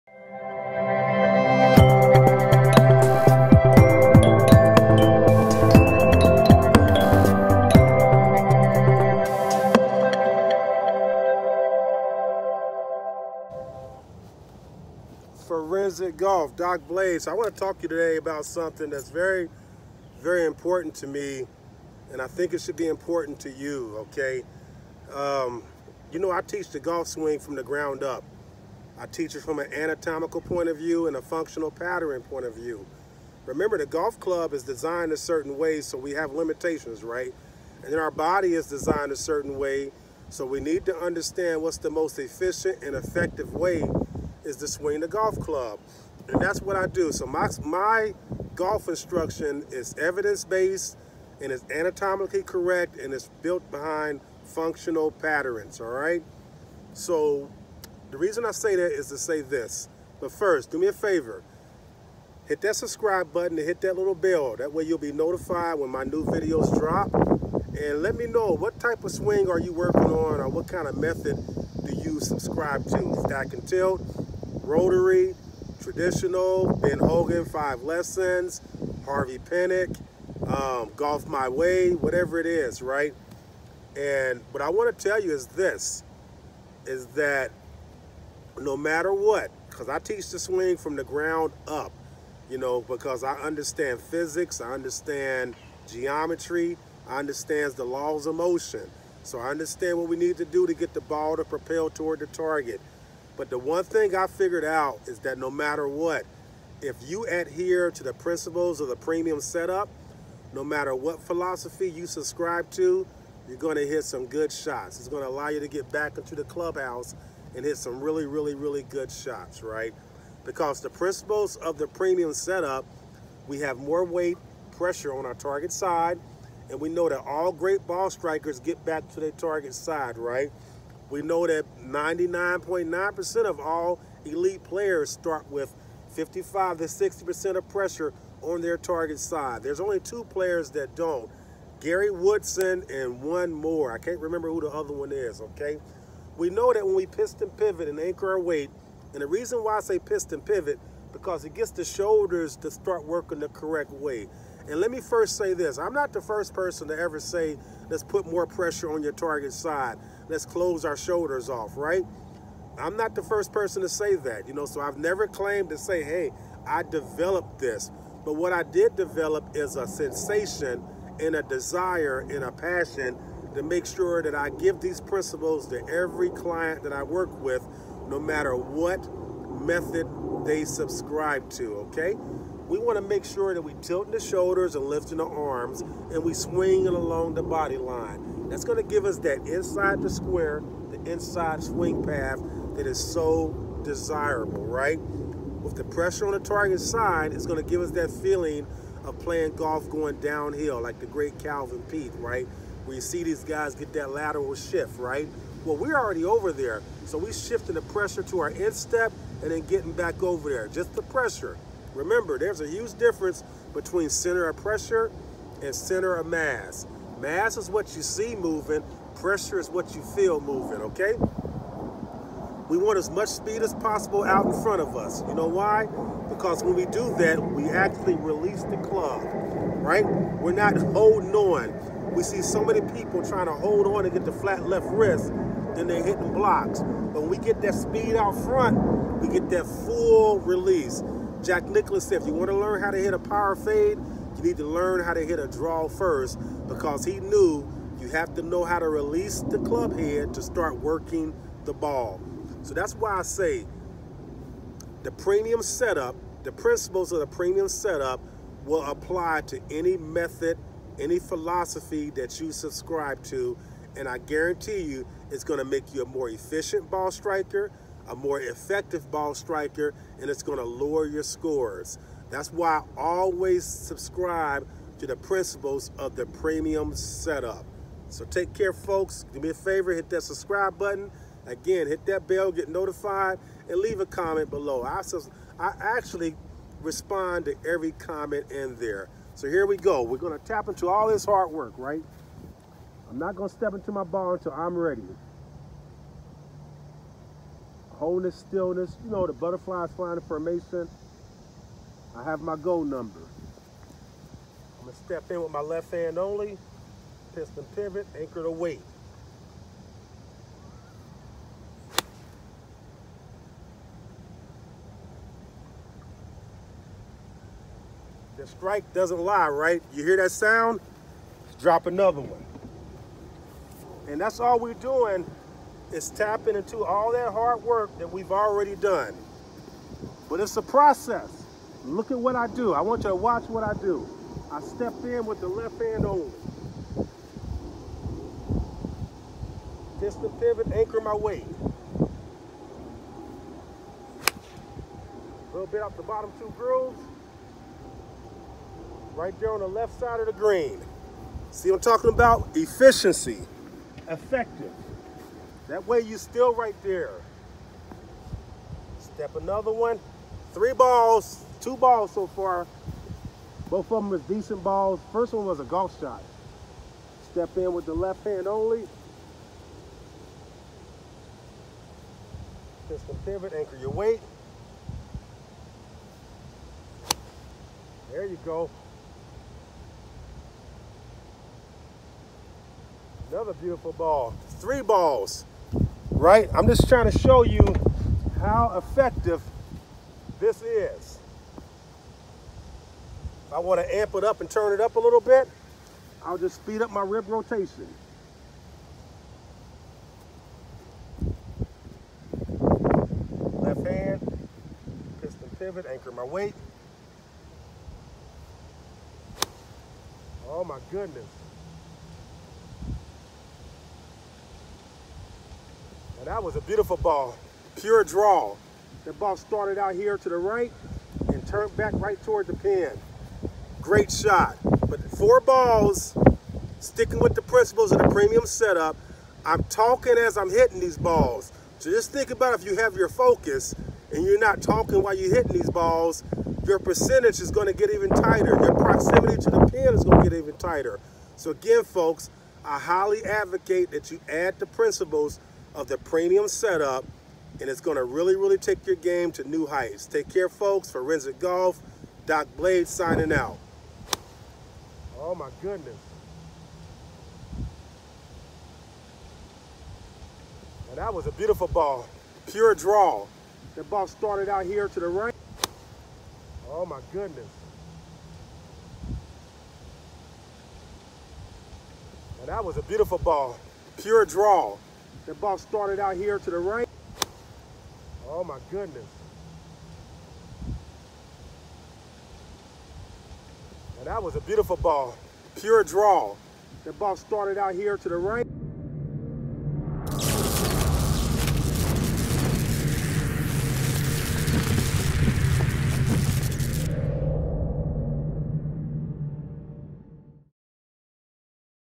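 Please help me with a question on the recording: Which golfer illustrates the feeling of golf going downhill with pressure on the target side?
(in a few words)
Calvin Peete.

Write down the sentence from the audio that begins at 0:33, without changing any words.
Remember, the golf club is designed a certain way, so we have limitations, right?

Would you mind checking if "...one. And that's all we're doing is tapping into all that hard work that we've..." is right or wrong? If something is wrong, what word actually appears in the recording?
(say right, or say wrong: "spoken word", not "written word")
right.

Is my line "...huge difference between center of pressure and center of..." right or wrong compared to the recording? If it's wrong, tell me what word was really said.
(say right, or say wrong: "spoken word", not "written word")
right.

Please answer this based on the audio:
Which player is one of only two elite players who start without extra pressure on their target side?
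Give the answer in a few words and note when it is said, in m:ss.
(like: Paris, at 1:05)
Gary Woodson, at 2:21.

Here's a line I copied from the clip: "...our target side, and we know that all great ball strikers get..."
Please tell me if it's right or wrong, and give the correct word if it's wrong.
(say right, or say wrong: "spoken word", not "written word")
right.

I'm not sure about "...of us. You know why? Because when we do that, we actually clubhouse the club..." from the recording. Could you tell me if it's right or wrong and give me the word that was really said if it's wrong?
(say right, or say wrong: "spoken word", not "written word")
wrong: "release", not "clubhouse".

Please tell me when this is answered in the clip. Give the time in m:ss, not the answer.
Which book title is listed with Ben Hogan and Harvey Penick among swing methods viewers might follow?
1:17.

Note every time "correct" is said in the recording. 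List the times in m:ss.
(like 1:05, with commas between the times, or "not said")
0:52, 2:33.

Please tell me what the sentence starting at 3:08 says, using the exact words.
That's going to give us that inside the square, the inside swing path that is so desirable, right?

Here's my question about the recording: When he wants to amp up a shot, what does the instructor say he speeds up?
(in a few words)
Rib rotation.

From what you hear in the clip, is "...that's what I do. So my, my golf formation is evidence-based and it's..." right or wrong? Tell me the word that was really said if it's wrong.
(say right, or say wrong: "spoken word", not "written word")
wrong: "instruction", not "formation".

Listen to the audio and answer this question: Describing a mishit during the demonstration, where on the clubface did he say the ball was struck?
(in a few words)
Bottom two grooves.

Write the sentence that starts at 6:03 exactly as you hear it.
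Both of them was decent balls.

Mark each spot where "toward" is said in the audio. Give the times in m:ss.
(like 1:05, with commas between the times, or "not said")
1:41, 7:02.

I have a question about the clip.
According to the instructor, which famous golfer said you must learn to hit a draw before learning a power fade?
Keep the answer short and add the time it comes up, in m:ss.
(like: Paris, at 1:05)
Jack Nicklaus, at 4:01.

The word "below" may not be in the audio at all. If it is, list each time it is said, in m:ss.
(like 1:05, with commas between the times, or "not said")
4:44.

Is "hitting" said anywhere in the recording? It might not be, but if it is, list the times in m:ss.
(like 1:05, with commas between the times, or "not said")
3:56, 7:10, 7:15.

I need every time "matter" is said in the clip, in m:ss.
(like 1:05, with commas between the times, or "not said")
1:28, 1:45, 1:50, 2:58.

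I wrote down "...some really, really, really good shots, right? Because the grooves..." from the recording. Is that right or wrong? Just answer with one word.
wrong.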